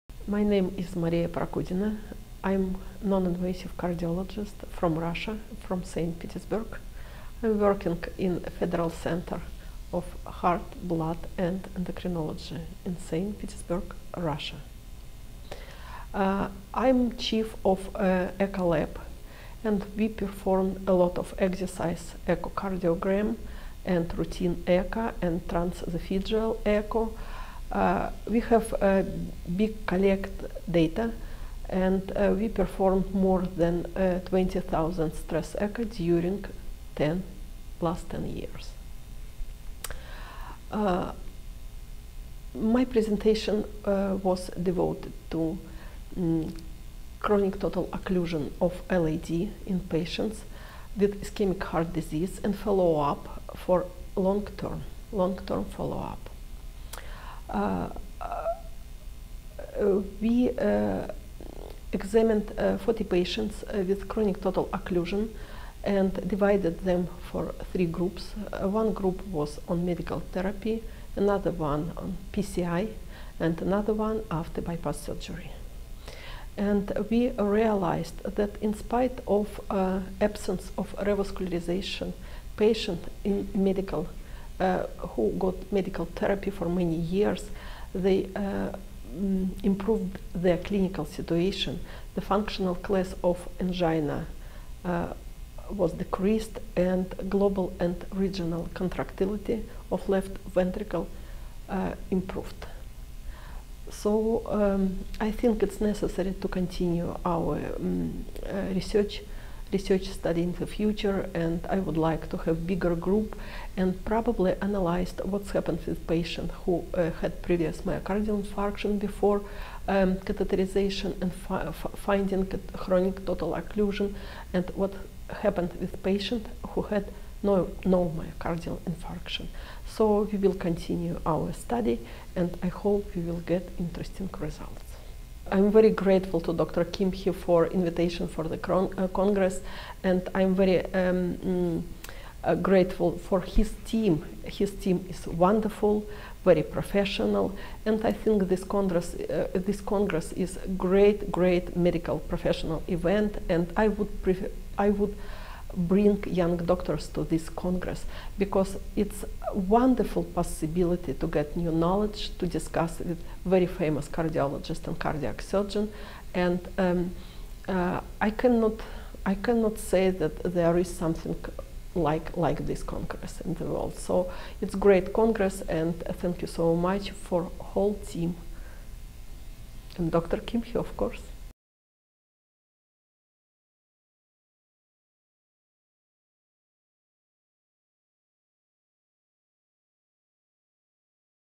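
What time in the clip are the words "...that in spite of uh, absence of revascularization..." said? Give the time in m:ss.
1:18.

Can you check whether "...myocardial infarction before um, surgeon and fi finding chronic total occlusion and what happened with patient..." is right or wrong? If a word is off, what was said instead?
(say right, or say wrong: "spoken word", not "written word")
wrong: "catheterization", not "surgeon".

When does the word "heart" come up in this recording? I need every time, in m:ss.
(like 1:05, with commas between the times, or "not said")
0:10, 0:51.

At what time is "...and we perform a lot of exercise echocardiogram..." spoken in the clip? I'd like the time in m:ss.
0:19.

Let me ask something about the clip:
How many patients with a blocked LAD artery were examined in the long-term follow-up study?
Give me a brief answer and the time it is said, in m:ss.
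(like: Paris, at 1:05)
40, at 1:02.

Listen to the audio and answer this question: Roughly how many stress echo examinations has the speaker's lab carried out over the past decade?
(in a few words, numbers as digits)
20,000.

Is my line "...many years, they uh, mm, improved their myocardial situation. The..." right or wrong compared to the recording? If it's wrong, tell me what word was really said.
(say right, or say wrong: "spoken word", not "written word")
wrong: "clinical", not "myocardial".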